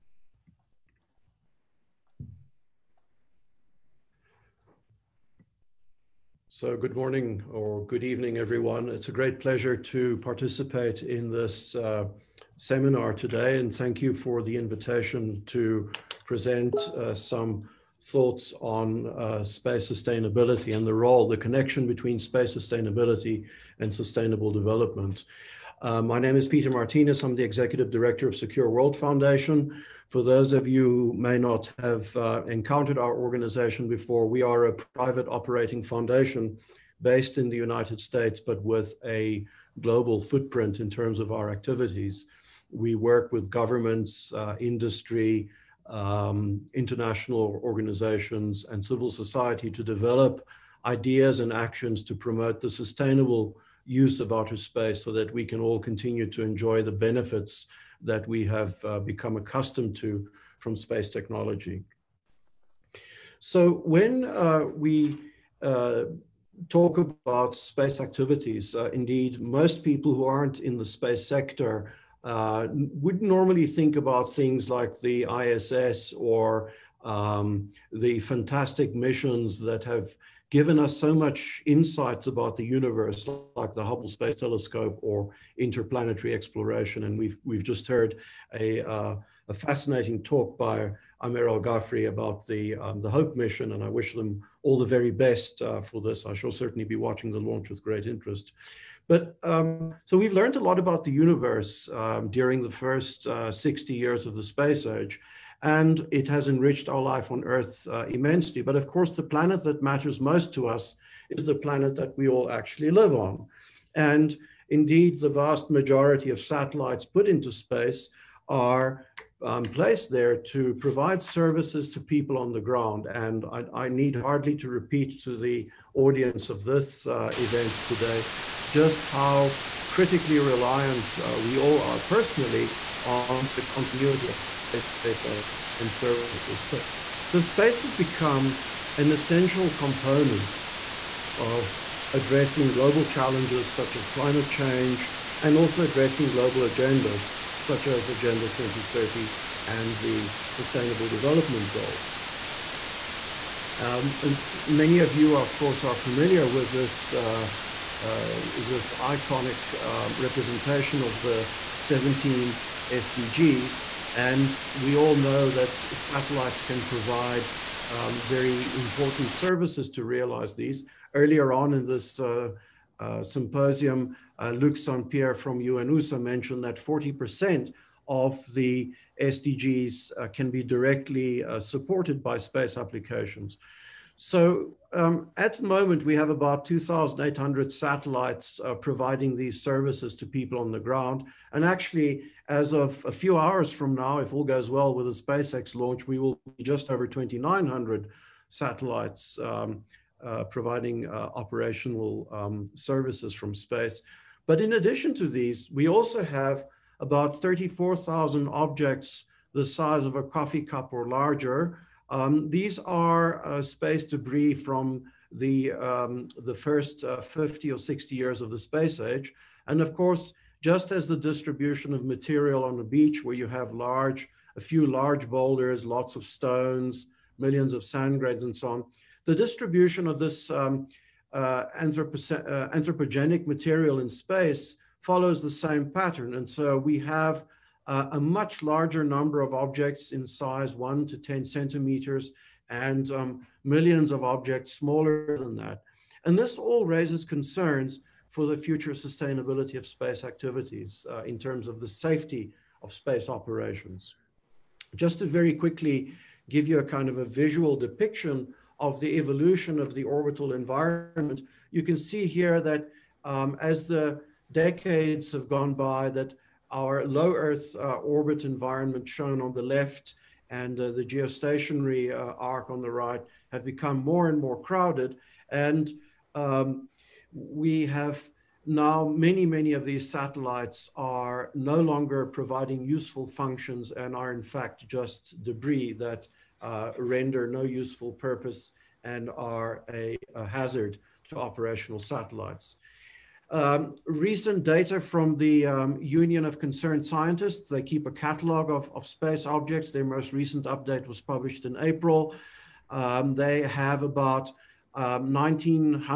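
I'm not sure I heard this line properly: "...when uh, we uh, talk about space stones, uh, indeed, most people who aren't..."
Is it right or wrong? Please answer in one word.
wrong.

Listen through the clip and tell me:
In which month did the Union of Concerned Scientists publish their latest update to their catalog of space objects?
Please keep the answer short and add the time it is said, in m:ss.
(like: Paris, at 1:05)
April, at 5:01.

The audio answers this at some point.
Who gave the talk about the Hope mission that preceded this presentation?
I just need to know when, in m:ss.
1:31.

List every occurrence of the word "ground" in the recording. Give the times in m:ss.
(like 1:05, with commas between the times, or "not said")
2:02, 3:10.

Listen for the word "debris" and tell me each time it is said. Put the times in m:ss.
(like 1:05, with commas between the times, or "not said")
3:34, 4:45.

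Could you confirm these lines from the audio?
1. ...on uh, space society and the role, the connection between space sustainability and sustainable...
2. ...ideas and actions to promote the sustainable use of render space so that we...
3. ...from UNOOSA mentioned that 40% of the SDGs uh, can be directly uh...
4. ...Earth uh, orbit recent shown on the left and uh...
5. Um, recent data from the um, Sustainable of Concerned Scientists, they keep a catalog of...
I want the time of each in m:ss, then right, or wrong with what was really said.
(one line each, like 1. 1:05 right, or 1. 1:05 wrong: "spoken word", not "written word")
1. 0:18 wrong: "sustainability", not "society"
2. 0:50 wrong: "outer", not "render"
3. 2:55 right
4. 4:27 wrong: "environment", not "recent"
5. 4:53 wrong: "Union", not "Sustainable".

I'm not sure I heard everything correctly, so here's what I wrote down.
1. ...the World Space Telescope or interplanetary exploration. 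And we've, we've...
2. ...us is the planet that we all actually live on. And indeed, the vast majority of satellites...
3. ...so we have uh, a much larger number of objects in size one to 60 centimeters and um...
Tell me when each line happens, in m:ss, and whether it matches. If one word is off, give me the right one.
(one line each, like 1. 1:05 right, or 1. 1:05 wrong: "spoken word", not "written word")
1. 1:23 wrong: "Hubble", not "World"
2. 1:50 right
3. 3:56 wrong: "10", not "60".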